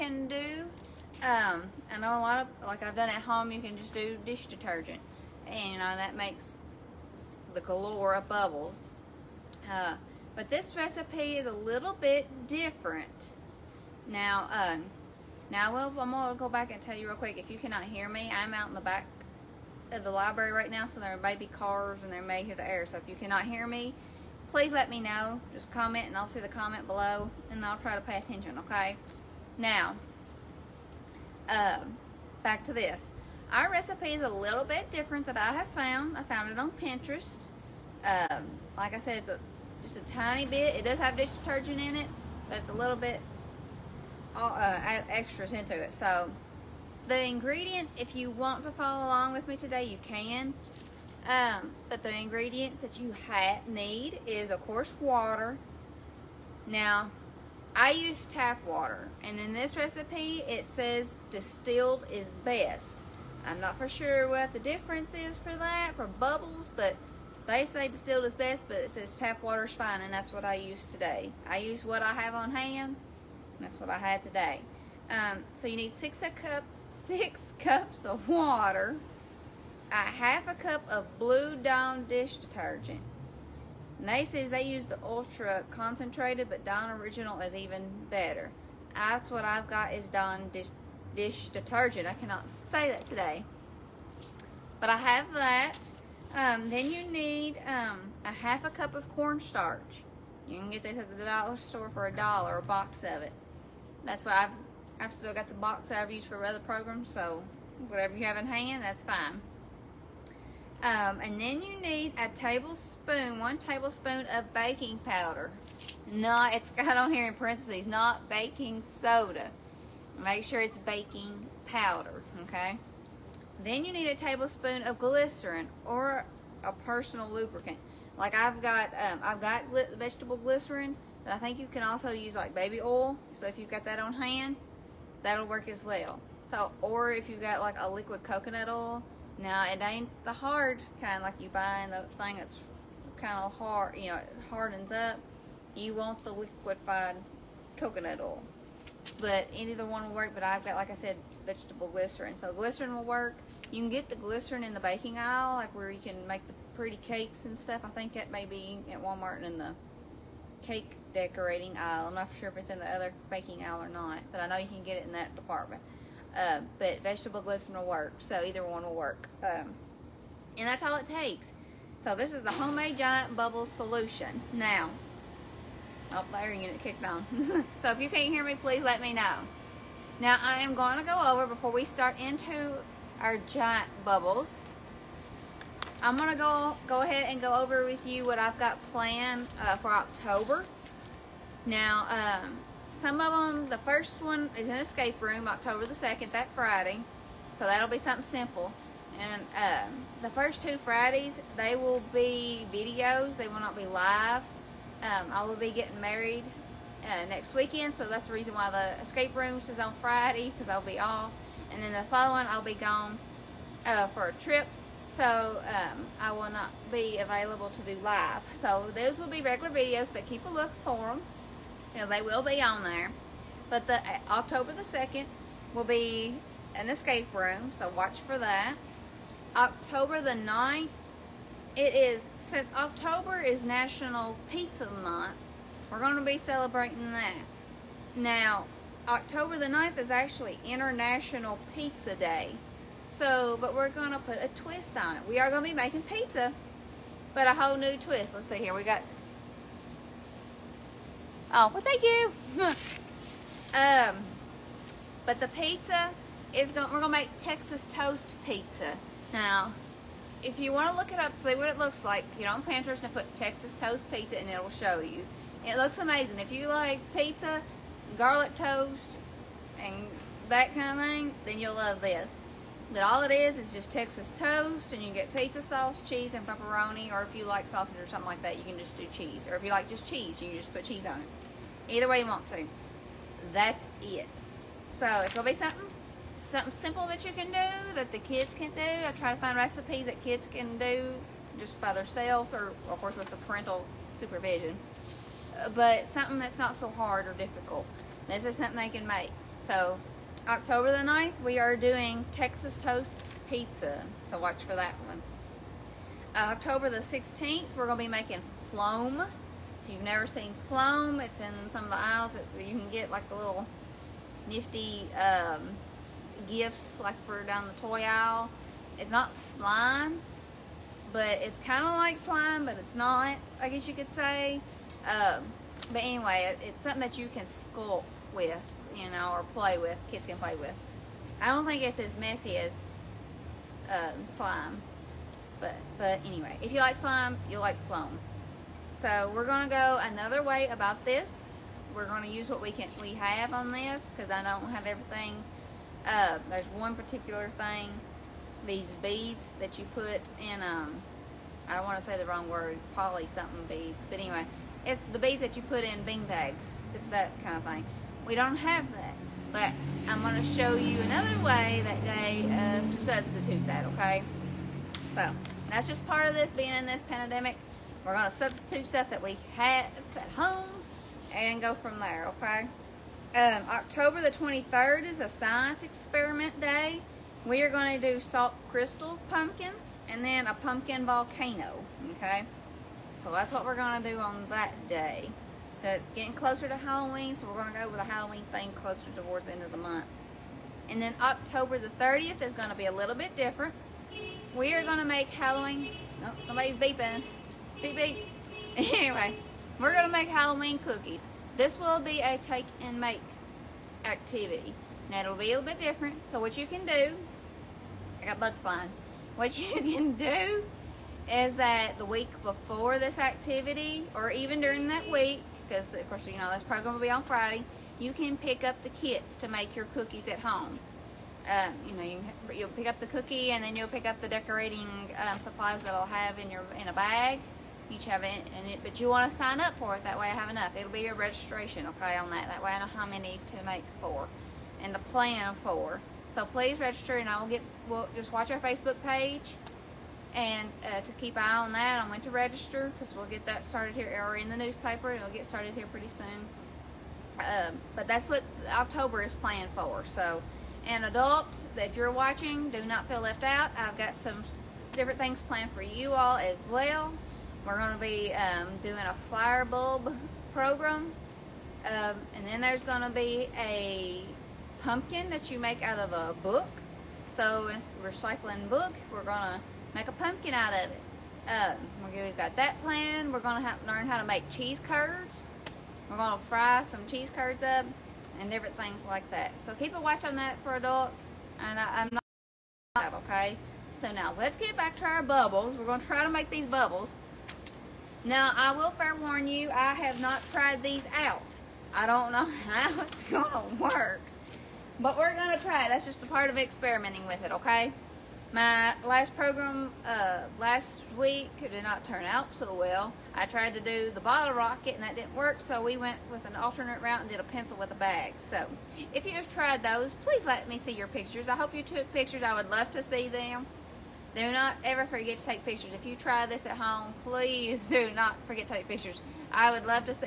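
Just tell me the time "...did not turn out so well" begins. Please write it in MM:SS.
08:21.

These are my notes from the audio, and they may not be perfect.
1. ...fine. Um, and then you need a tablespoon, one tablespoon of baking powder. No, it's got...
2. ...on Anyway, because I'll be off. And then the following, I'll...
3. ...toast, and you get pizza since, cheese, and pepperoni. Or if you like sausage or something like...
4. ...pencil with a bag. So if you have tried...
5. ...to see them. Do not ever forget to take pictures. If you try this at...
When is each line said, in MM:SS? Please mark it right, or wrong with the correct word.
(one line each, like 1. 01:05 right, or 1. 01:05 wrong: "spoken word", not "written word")
1. 01:49 right
2. 03:29 wrong: "Friday", not "Anyway"
3. 04:34 wrong: "sauce", not "since"
4. 08:27 right
5. 08:32 right.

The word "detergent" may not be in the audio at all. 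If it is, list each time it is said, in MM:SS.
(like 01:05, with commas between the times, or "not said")
00:04, 00:41, 01:22, 01:31.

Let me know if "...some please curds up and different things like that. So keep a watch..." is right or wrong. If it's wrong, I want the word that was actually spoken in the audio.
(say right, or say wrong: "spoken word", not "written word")
wrong: "cheese", not "please".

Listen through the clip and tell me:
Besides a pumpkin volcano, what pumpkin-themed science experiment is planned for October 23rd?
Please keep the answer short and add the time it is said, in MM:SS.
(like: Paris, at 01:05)
salt crystal pumpkins, at 06:18.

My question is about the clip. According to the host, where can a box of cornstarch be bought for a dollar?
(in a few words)
the dollar store.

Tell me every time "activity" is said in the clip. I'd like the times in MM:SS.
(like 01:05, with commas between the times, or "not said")
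06:44, 06:53.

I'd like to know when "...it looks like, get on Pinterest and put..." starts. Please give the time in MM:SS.
04:21.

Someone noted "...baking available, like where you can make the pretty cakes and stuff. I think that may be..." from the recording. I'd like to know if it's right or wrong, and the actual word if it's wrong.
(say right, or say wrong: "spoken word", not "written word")
wrong: "aisle", not "available".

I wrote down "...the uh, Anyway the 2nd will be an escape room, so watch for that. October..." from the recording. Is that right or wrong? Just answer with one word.
wrong.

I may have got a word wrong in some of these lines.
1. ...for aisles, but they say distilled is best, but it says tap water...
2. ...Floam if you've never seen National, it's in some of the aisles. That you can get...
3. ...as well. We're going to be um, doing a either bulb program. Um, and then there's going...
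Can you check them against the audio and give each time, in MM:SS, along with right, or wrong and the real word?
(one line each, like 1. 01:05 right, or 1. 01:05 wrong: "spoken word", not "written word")
1. 01:05 wrong: "bubbles", not "aisles"
2. 05:08 wrong: "Floam", not "National"
3. 07:36 wrong: "flower", not "either".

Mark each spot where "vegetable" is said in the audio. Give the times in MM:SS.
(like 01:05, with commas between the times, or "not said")
02:09, 02:31, 02:47.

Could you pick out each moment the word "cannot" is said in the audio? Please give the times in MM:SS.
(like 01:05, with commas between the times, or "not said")
00:17, 00:23, 01:32.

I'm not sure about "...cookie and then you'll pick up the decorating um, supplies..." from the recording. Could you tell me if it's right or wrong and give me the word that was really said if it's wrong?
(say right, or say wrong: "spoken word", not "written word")
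right.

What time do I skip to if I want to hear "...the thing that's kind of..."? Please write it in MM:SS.
02:21.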